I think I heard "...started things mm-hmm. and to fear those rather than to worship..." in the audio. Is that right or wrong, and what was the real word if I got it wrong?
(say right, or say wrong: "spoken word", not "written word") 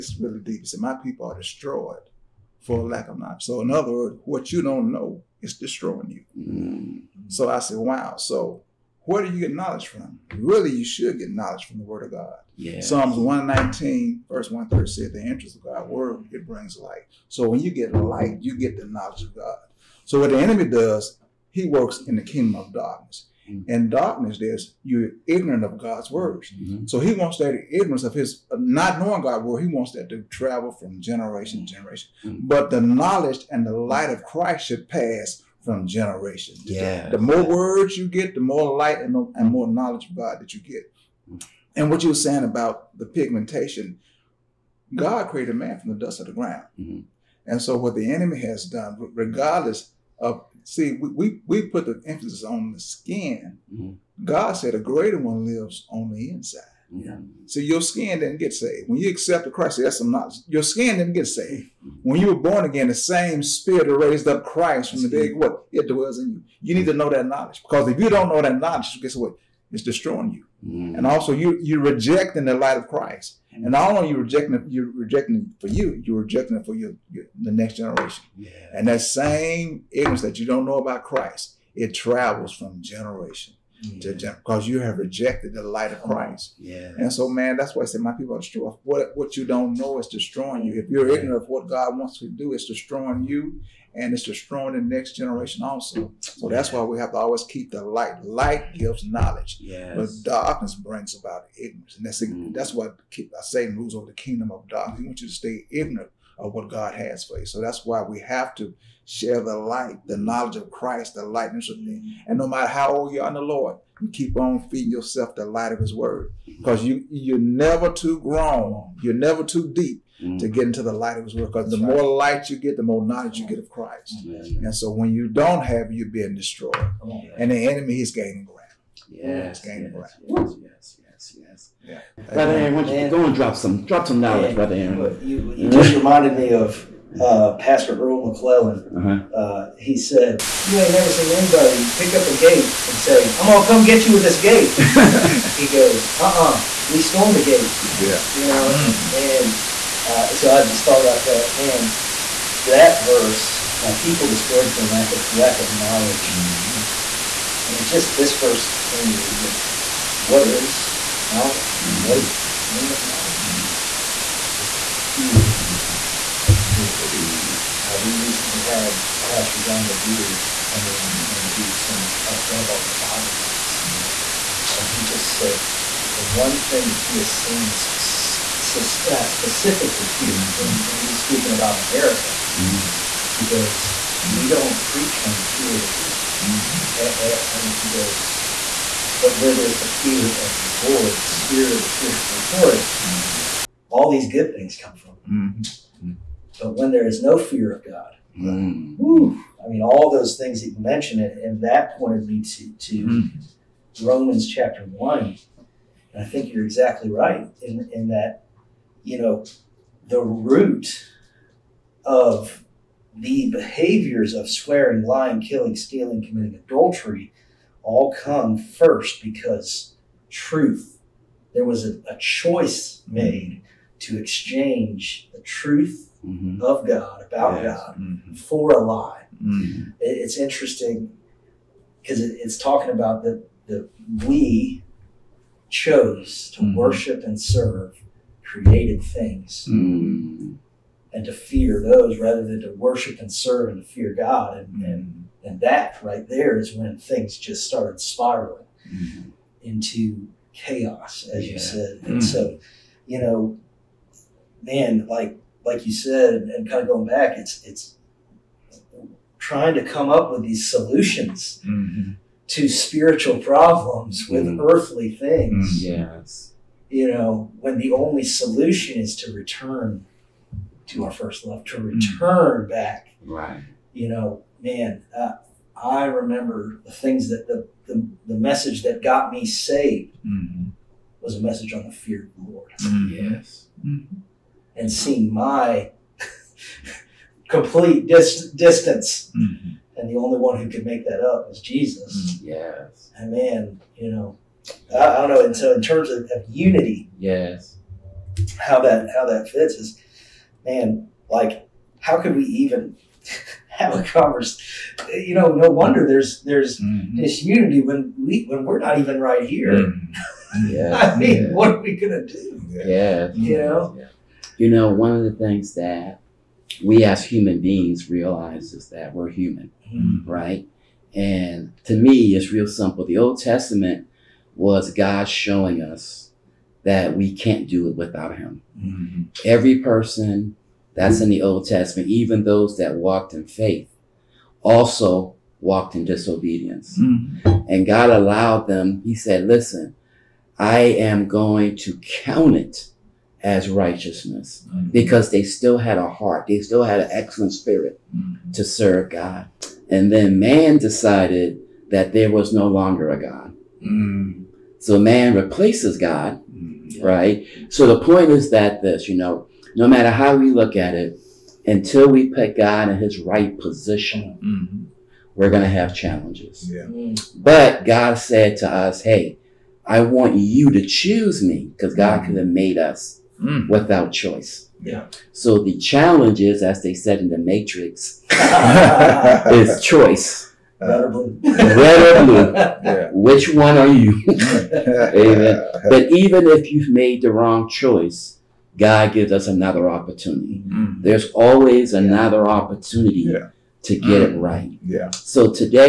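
wrong: "created", not "started".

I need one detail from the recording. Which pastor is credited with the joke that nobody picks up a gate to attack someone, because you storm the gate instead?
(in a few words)
Earl McClellan.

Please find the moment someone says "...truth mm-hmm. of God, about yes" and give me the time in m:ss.
3:45.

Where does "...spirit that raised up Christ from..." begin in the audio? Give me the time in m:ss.
1:03.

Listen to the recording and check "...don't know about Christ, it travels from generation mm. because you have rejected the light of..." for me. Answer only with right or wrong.
right.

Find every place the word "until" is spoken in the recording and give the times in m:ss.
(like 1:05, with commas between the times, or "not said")
6:01.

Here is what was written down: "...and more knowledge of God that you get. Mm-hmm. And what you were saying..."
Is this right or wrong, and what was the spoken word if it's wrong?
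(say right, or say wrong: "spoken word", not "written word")
right.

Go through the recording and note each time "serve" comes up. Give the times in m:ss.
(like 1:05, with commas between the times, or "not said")
3:57, 4:03, 5:48.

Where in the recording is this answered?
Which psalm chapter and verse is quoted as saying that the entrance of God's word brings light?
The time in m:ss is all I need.
0:12.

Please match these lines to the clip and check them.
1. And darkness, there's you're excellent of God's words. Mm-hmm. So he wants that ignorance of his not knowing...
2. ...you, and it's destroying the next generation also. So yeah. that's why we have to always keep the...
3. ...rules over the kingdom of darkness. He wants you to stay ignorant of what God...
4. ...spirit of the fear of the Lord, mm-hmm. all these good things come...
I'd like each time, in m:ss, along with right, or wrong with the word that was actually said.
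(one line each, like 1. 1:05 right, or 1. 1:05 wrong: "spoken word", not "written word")
1. 0:23 wrong: "ignorant", not "excellent"
2. 1:33 right
3. 1:43 right
4. 3:11 right.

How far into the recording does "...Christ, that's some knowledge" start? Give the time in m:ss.
0:59.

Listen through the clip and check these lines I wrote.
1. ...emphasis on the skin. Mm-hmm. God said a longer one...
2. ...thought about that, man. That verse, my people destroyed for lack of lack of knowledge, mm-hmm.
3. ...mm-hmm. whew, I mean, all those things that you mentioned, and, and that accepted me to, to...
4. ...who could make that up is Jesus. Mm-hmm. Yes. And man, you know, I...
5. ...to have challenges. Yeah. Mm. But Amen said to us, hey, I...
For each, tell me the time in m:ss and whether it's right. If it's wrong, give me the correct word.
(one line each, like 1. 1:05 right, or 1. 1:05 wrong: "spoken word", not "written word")
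1. 0:52 wrong: "greater", not "longer"
2. 2:30 right
3. 3:18 wrong: "pointed", not "accepted"
4. 4:50 right
5. 6:05 wrong: "God", not "Amen".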